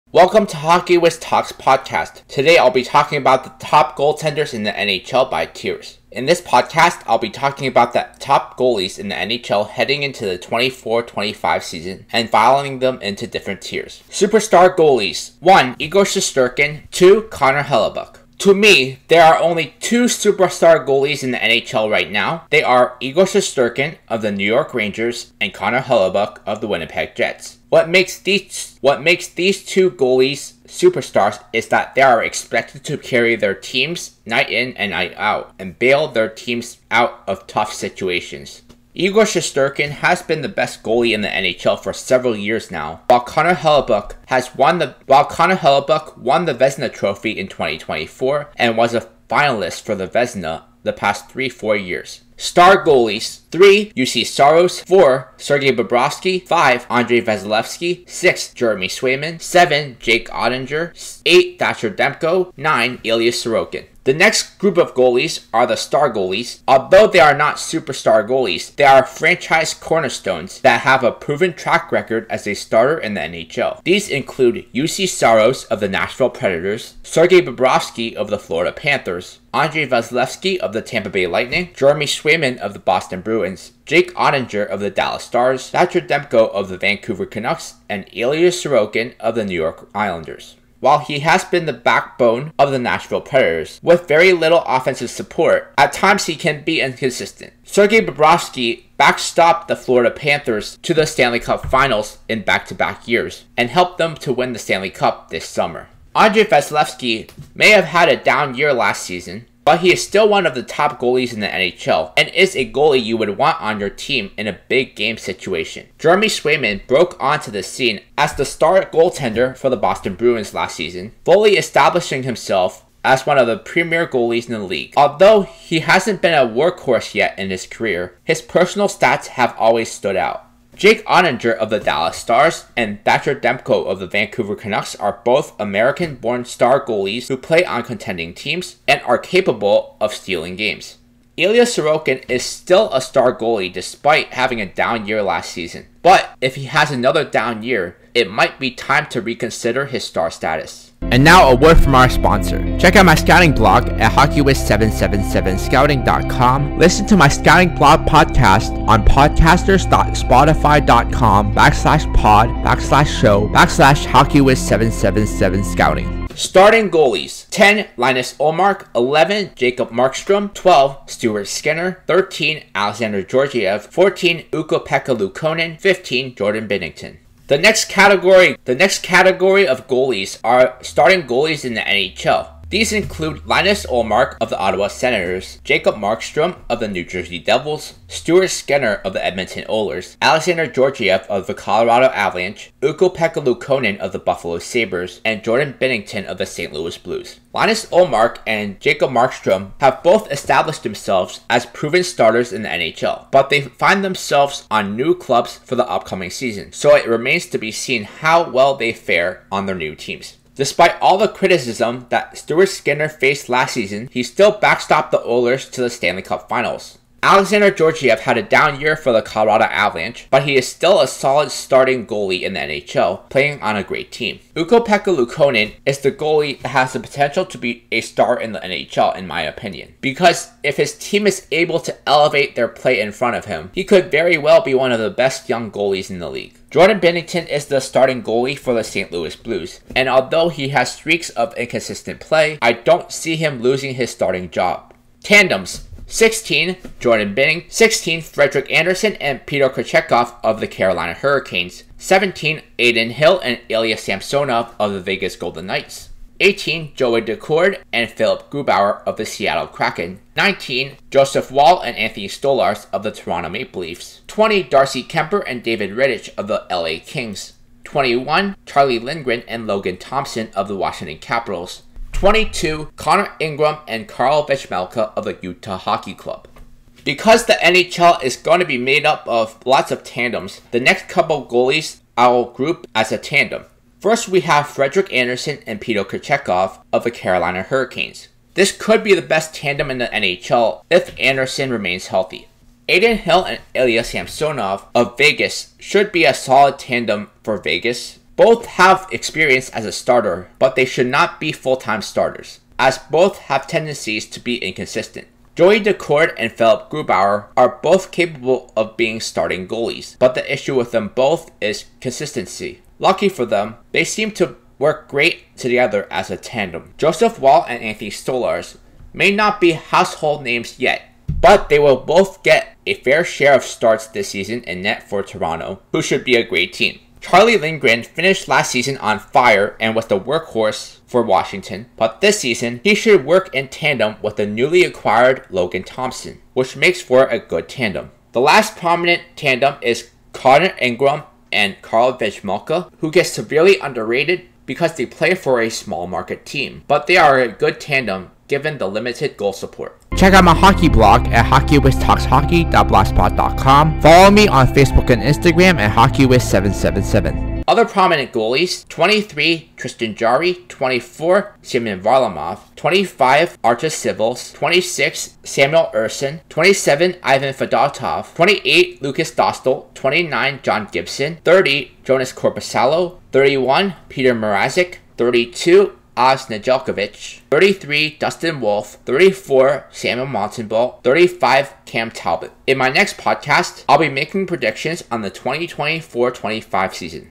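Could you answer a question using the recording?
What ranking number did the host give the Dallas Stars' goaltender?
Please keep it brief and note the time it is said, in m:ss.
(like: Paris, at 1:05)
7, at 0:59.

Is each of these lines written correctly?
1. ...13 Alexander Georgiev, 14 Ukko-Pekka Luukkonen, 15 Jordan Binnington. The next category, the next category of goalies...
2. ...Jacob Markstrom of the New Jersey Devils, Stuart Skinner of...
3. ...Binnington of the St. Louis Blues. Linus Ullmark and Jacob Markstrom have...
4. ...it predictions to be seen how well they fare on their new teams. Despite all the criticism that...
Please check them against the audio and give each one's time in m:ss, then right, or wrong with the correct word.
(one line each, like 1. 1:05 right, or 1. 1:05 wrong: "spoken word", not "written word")
1. 2:52 right
2. 3:05 right
3. 3:15 right
4. 3:26 wrong: "remains", not "predictions".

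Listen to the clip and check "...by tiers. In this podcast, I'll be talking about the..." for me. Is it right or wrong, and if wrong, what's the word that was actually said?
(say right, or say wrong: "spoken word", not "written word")
right.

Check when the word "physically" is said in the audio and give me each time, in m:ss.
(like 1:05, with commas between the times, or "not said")
not said.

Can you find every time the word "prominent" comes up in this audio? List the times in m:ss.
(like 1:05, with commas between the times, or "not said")
5:38, 5:57.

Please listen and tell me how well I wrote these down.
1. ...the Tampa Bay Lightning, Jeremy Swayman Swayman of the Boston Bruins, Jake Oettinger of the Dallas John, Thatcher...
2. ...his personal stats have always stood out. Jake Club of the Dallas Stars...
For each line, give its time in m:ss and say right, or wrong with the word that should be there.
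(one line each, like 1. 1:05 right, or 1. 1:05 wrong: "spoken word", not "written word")
1. 1:20 wrong: "Stars", not "John"
2. 2:08 wrong: "Oettinger", not "Club".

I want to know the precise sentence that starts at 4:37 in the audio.
Because the NHL is going to be made up of lots of tandems, the next couple goalies I'll group as a tandem.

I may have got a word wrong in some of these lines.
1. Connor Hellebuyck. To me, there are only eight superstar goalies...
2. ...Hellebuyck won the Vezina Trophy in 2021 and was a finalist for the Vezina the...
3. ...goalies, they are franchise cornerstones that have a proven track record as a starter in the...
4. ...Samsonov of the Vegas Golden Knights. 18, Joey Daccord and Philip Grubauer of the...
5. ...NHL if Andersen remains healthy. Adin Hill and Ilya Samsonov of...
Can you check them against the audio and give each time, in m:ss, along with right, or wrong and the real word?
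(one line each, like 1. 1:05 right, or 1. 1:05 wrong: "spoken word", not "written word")
1. 0:17 wrong: "two", not "eight"
2. 0:45 wrong: "2024", not "2021"
3. 1:08 right
4. 4:13 right
5. 4:50 right.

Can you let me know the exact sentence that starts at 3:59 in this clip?
Louis Blues, and although he has streaks of inconsistent play, I don't see him losing his starting job.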